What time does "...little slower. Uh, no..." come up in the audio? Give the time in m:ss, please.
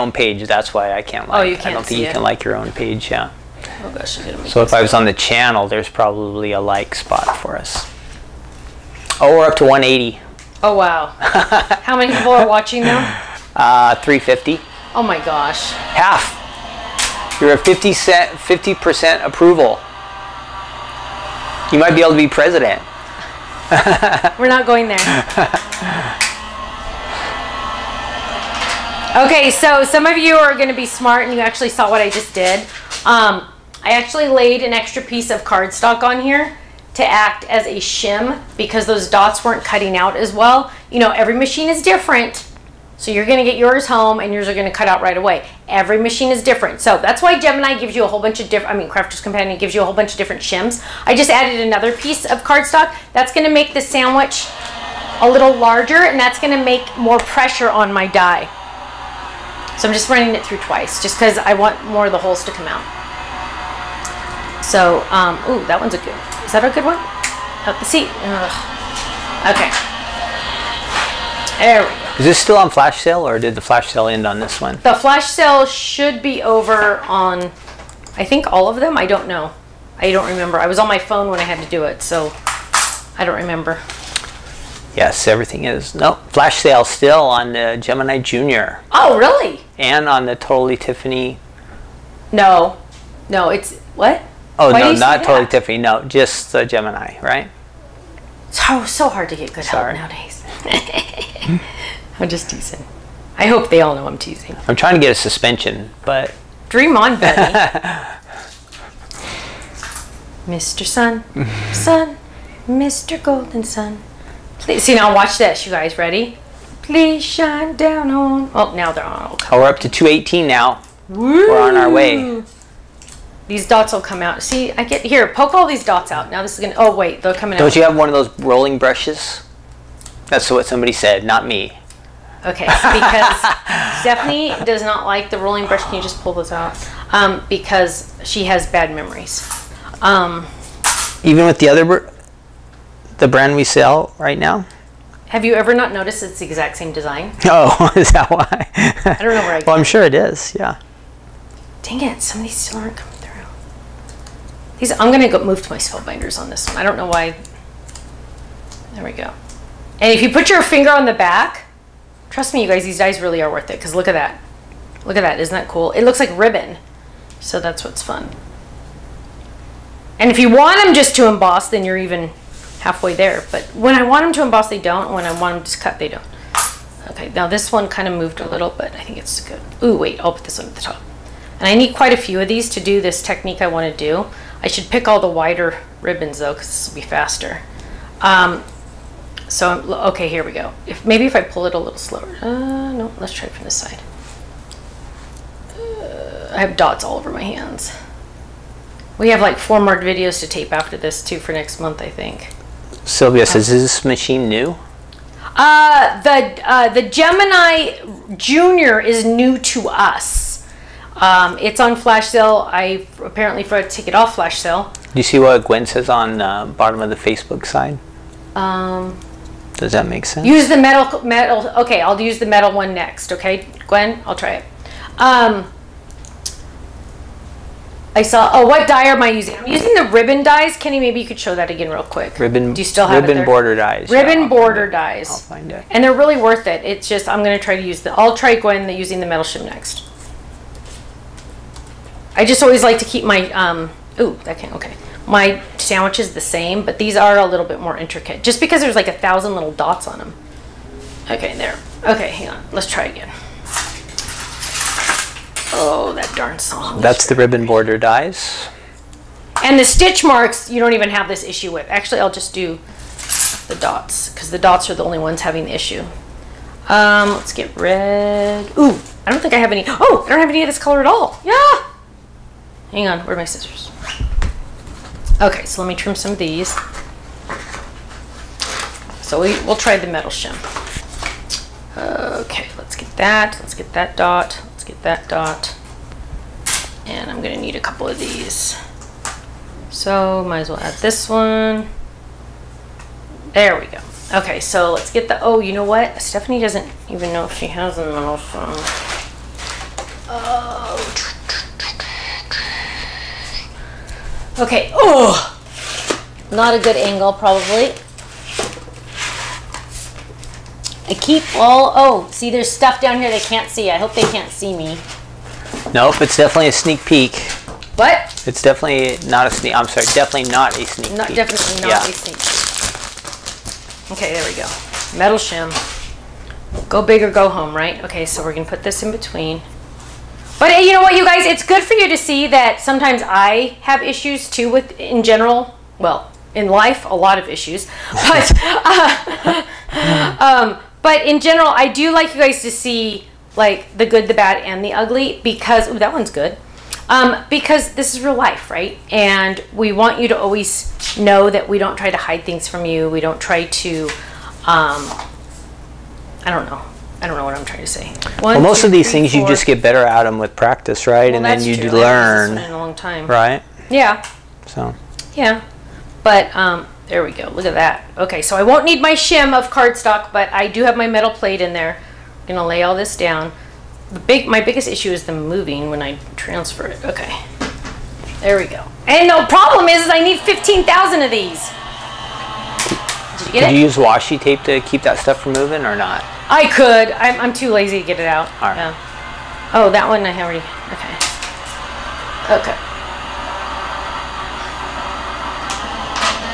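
3:11.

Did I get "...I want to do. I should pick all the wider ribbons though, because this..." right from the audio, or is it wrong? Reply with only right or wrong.
right.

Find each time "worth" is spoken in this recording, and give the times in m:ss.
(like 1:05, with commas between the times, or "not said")
2:43, 3:56.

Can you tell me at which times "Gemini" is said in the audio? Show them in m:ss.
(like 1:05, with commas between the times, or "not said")
0:47, 1:27, 1:36, 3:27.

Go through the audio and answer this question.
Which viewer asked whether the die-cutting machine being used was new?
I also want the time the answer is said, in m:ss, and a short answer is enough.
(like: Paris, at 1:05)
Sylvia, at 3:23.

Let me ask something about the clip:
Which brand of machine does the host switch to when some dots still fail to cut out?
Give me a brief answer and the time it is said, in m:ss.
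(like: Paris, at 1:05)
Spellbinders, at 2:35.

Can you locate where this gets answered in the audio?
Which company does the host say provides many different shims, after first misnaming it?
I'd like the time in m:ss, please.
0:48.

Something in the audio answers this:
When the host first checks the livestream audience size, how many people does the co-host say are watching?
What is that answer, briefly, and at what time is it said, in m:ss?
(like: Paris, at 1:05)
350, at 0:13.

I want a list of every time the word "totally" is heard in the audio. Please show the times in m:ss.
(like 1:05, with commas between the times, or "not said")
1:30, 1:35.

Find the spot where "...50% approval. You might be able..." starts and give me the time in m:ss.
0:18.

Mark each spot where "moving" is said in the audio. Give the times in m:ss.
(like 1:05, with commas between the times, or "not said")
6:15, 6:25.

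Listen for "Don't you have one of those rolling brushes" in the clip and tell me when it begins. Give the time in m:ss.
2:07.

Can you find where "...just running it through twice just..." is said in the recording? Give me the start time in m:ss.
0:59.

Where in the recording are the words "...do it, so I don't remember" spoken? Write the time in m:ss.
1:21.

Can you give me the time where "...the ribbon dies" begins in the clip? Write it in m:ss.
3:49.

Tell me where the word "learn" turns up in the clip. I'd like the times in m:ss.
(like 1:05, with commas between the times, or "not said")
6:01.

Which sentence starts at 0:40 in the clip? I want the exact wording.
You know, every machine is different.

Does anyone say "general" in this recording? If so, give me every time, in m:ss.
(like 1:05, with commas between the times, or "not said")
5:35, 5:41.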